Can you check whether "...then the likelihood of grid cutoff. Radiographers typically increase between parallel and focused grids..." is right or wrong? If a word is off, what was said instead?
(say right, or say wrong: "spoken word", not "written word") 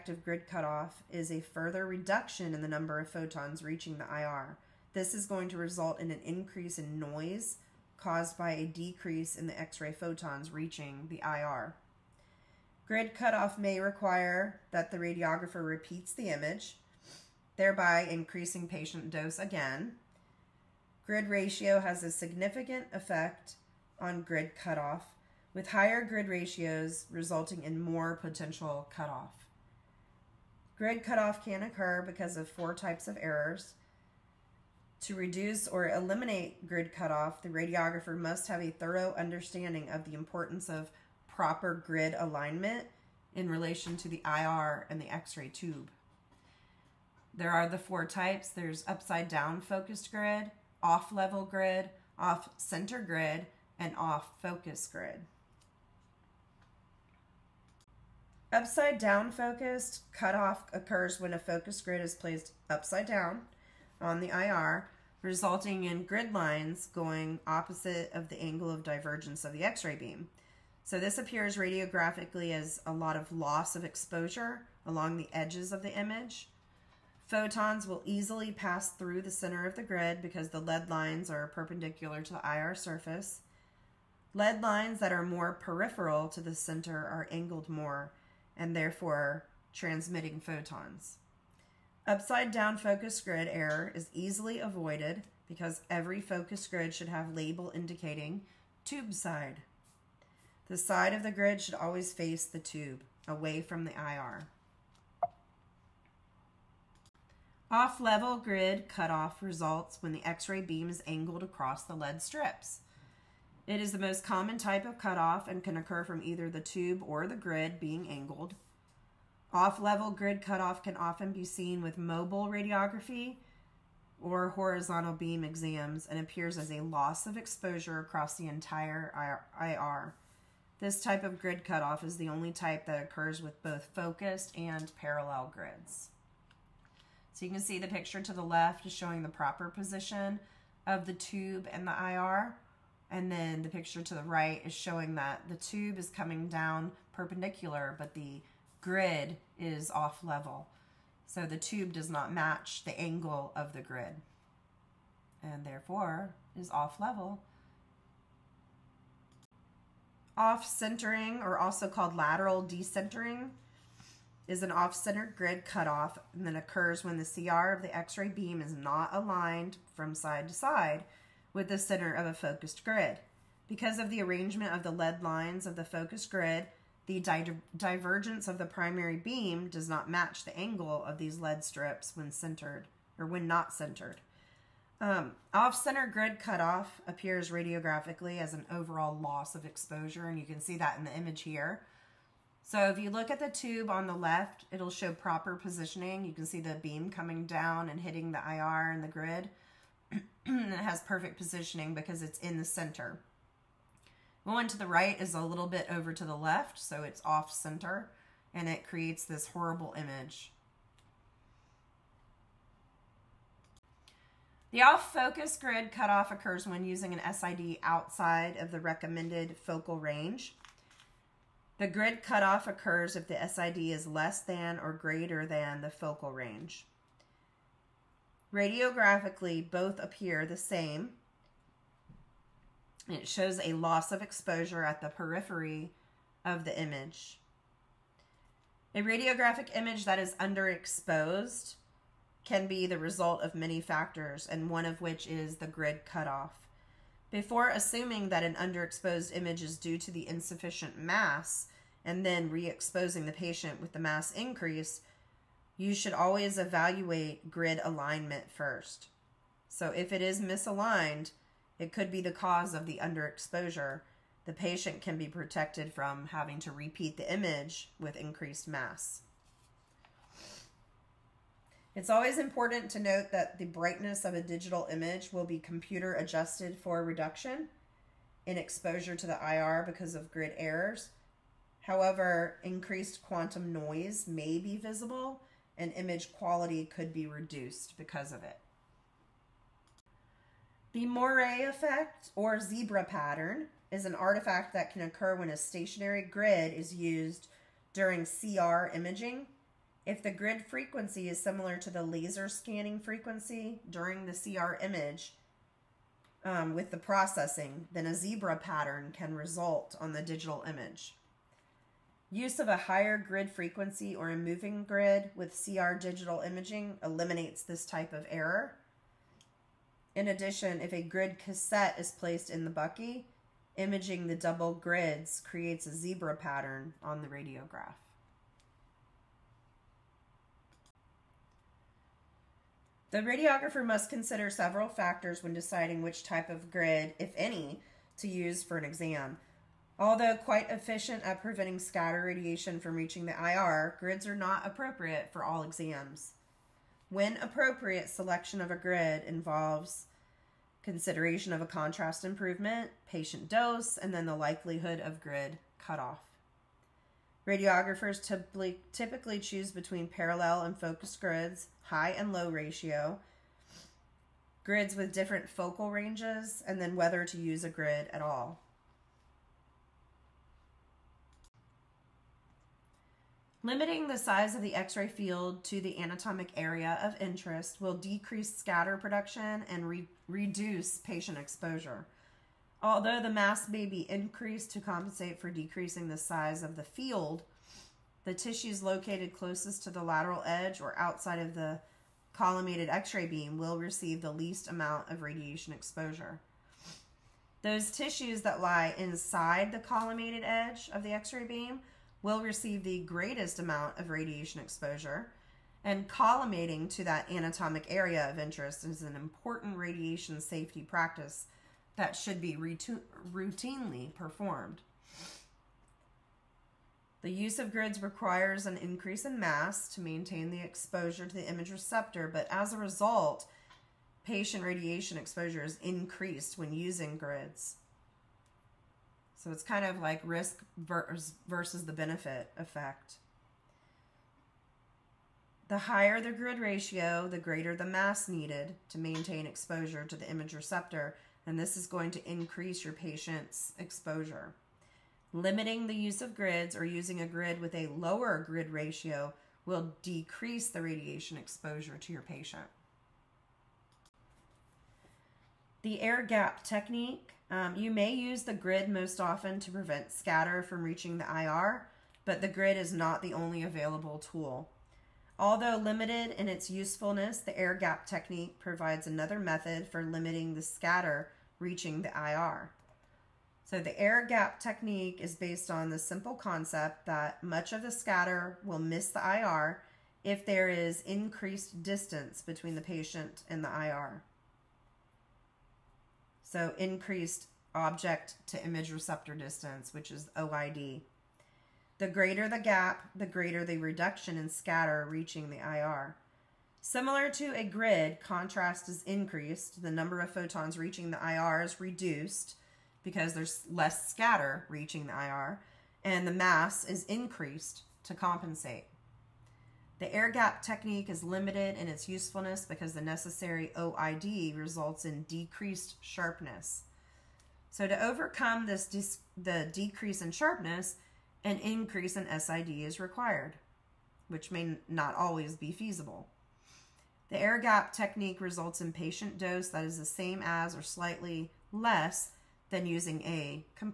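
wrong: "choose", not "increase".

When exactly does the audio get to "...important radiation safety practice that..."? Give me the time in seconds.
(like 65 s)
409 s.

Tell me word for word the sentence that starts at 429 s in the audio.
So it's kind of like risk versus the benefit effect.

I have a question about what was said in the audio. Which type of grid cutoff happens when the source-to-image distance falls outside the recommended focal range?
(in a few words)
Off-focus grid cutoff.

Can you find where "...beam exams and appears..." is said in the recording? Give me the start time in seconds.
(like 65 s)
125 s.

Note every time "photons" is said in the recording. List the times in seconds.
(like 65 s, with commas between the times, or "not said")
3 s, 9 s, 77 s, 90 s, 500 s.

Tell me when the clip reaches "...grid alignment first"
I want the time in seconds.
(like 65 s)
257 s.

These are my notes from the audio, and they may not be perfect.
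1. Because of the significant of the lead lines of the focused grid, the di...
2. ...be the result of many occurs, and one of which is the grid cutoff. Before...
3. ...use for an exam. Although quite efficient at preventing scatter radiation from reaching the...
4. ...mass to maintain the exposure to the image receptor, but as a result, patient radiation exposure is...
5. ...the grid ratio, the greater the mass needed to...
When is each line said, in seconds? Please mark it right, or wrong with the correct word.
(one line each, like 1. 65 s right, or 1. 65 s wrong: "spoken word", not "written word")
1. 173 s wrong: "arrangement", not "significant"
2. 242 s wrong: "factors", not "occurs"
3. 338 s right
4. 419 s right
5. 436 s right.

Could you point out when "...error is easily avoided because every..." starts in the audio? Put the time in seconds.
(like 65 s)
93 s.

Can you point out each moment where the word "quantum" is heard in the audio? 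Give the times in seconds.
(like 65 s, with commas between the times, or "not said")
283 s.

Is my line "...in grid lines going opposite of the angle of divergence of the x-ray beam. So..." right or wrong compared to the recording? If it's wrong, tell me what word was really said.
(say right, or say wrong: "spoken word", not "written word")
right.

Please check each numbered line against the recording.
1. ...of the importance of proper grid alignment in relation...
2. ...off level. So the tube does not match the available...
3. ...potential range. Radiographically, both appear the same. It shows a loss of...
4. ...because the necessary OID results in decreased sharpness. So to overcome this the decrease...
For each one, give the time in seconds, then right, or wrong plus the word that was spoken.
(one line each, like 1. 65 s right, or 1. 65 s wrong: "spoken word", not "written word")
1. 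39 s right
2. 149 s wrong: "angle", not "available"
3. 225 s wrong: "focal", not "potential"
4. 512 s right.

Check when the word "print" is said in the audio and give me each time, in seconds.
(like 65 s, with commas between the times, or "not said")
not said.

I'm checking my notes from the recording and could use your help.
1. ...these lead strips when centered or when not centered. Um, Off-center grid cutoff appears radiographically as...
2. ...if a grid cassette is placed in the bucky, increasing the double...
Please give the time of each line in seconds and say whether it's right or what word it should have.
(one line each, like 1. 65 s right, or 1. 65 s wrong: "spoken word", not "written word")
1. 181 s right
2. 320 s wrong: "imaging", not "increasing".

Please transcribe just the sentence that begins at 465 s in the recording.
Although limited in its usefulness, the air gap technique provides another method for limiting the scatter reaching the IR.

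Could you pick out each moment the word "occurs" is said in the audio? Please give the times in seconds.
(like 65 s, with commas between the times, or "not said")
31 s, 60 s, 115 s, 133 s, 166 s, 216 s, 222 s, 294 s.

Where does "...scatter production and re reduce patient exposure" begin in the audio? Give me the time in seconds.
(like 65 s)
378 s.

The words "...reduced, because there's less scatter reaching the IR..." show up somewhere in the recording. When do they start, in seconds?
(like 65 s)
501 s.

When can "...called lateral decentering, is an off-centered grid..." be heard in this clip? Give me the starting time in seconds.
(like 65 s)
161 s.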